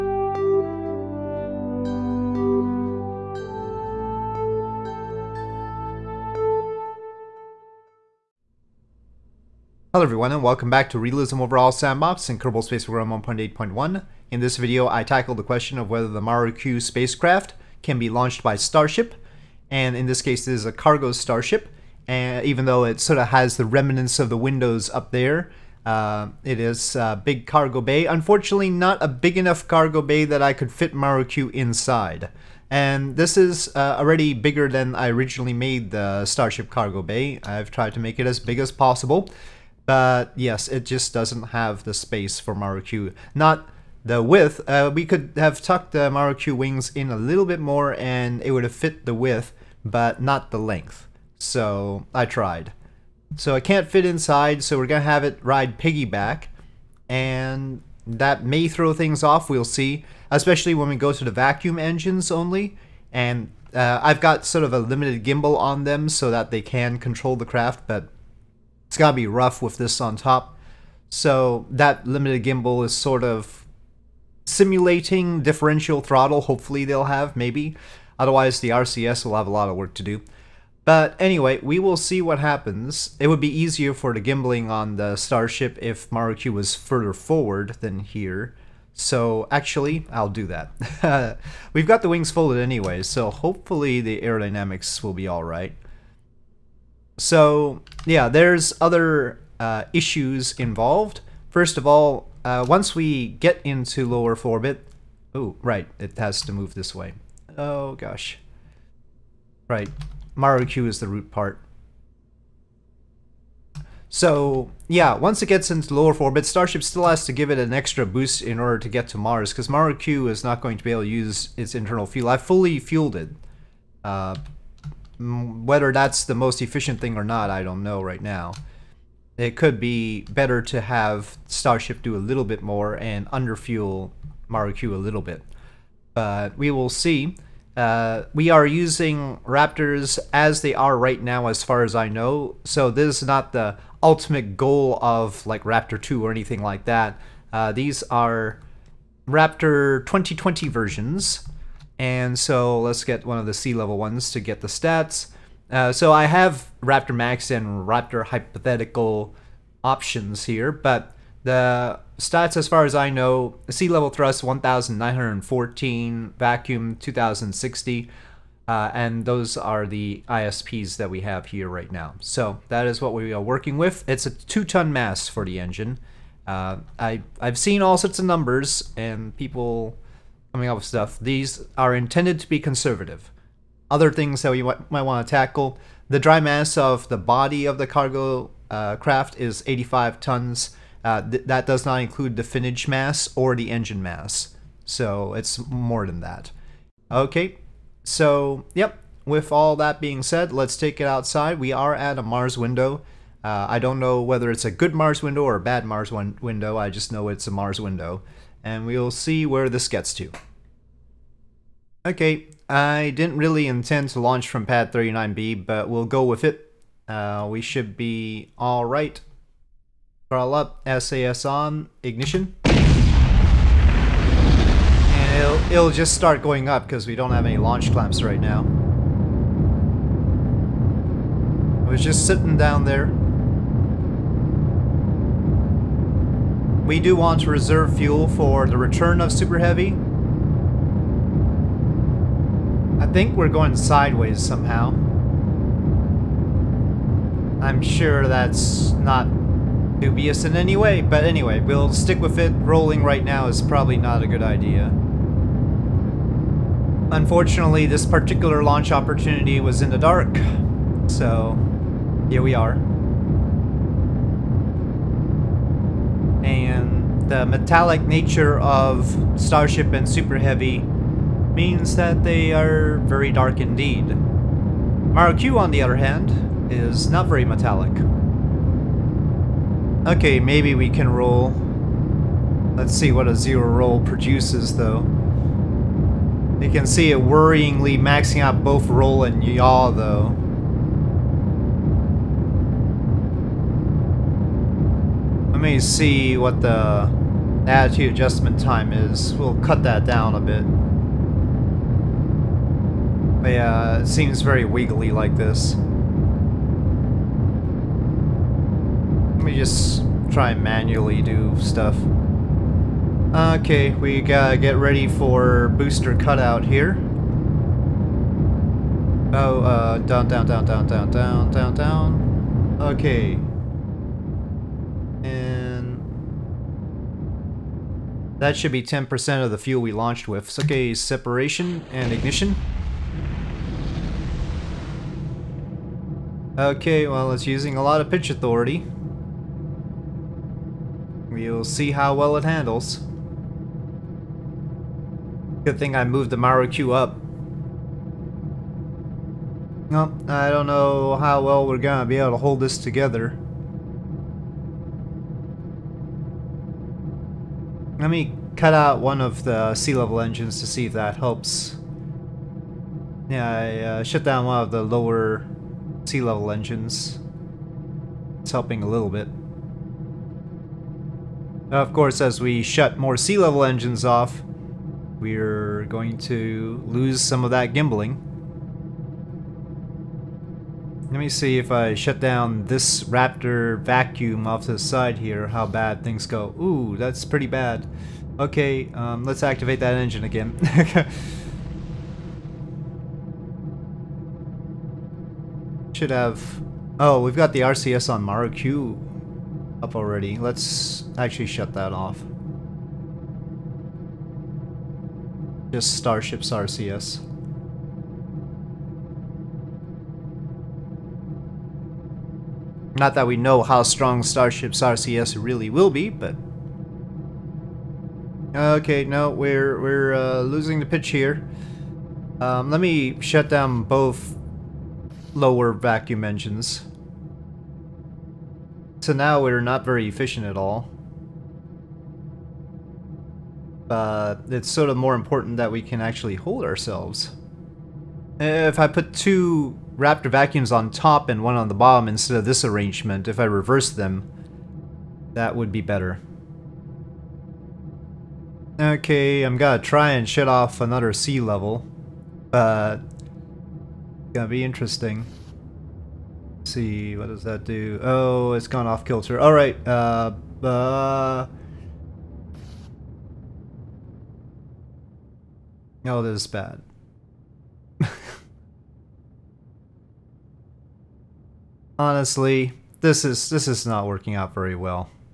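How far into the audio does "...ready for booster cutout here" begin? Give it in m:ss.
5:14.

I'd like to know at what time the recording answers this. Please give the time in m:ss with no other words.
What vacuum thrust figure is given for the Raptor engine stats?
2:46.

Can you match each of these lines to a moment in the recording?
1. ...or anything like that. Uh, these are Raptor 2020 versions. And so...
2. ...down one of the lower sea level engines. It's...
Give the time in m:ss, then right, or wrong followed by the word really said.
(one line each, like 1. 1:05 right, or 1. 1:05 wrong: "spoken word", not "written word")
1. 2:26 right
2. 6:04 right.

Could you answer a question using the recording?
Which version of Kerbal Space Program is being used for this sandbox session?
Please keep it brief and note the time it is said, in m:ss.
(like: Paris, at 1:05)
1.8.1, at 0:13.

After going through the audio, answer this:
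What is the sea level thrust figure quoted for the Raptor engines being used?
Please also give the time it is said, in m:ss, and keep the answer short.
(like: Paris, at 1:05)
1914, at 2:44.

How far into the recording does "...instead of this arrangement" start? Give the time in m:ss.
7:22.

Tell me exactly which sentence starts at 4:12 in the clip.
Rolling right now is probably not a good idea.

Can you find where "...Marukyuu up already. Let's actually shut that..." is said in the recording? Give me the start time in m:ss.
6:38.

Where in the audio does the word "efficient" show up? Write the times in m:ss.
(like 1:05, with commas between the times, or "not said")
2:06, 7:10.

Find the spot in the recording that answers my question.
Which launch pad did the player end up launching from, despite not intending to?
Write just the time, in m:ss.
3:34.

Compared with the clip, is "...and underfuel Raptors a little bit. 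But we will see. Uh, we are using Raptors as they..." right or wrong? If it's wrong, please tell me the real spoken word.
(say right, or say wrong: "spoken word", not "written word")
wrong: "Marukyuu", not "Raptors".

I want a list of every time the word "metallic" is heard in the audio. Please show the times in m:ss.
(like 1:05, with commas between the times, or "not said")
4:27, 4:37.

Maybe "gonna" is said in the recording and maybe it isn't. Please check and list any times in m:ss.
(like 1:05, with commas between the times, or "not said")
5:51, 7:29, 7:34.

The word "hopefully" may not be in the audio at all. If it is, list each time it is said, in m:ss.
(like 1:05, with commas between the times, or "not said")
1:16, 1:33.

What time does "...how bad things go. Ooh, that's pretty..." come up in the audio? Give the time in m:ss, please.
6:25.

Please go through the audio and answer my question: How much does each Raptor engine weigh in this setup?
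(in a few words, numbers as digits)
2 tons.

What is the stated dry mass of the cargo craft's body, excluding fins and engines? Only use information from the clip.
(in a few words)
85 tons.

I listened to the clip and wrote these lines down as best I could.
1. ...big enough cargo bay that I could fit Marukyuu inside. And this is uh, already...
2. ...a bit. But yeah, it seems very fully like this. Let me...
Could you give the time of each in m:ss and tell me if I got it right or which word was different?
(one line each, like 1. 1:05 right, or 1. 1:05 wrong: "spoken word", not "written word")
1. 0:29 right
2. 5:00 wrong: "wiggly", not "fully".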